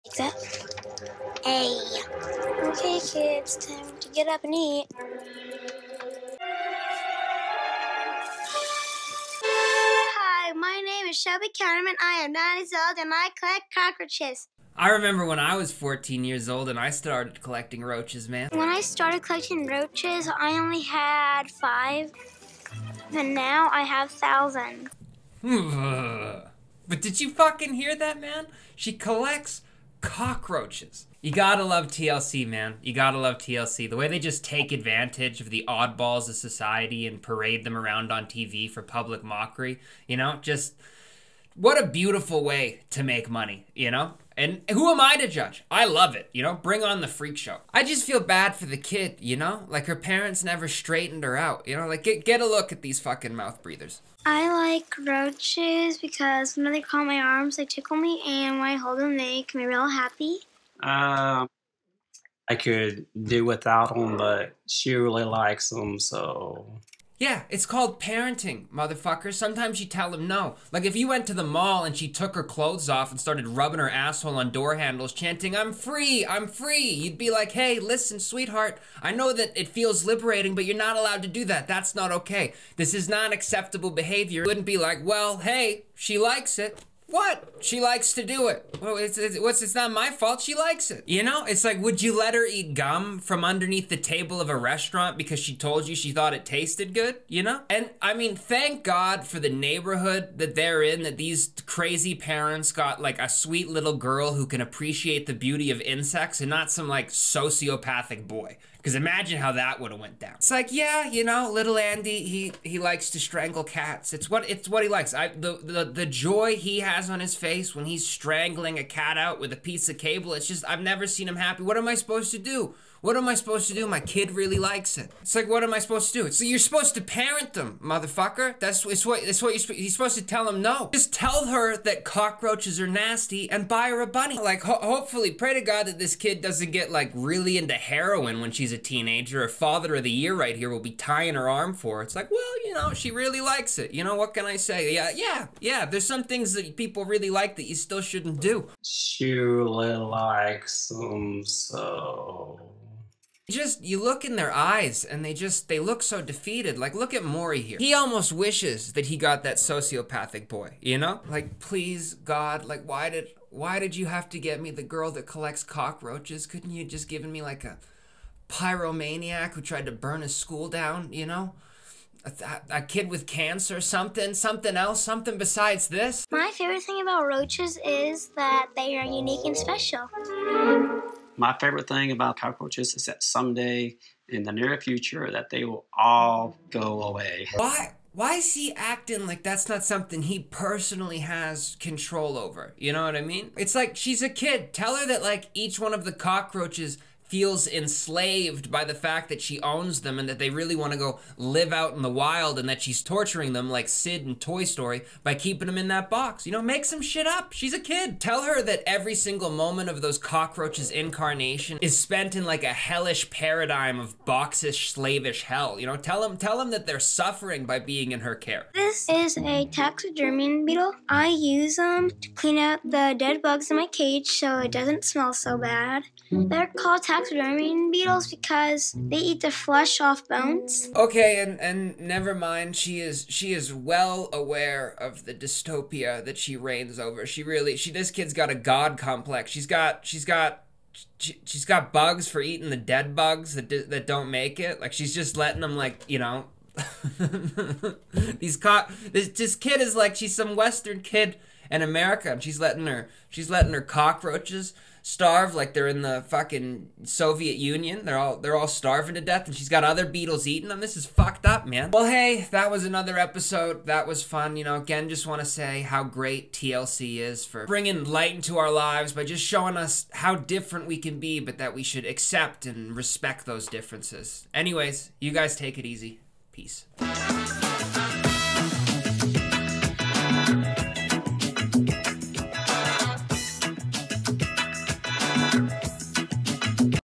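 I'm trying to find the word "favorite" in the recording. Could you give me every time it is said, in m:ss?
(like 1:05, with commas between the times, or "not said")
2:56, 3:01.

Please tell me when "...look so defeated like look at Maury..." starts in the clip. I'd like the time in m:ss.
2:35.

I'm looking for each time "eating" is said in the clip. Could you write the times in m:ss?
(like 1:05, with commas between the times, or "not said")
4:02, 4:20.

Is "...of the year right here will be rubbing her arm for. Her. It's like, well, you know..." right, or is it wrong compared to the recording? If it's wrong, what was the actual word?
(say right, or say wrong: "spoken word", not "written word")
wrong: "tying", not "rubbing".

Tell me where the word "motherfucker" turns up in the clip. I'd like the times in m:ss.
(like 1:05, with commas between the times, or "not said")
1:08, 2:07.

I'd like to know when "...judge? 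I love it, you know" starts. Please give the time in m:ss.
0:45.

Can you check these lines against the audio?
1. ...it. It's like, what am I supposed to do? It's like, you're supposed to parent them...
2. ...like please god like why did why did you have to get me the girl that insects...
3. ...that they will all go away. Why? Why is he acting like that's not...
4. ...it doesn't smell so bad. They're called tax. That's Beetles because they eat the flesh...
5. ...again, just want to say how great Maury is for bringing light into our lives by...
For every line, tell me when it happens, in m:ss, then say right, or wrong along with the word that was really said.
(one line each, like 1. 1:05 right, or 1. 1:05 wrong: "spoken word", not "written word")
1. 2:04 right
2. 2:41 wrong: "collects", not "insects"
3. 3:05 right
4. 3:44 right
5. 4:24 wrong: "TLC", not "Maury".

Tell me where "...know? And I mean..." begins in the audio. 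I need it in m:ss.
1:37.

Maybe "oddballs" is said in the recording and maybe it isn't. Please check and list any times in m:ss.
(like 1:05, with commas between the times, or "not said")
0:35.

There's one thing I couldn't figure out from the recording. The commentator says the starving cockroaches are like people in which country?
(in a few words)
Soviet Union.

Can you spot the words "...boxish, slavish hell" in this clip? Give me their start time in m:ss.
3:34.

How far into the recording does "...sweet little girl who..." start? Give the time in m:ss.
1:43.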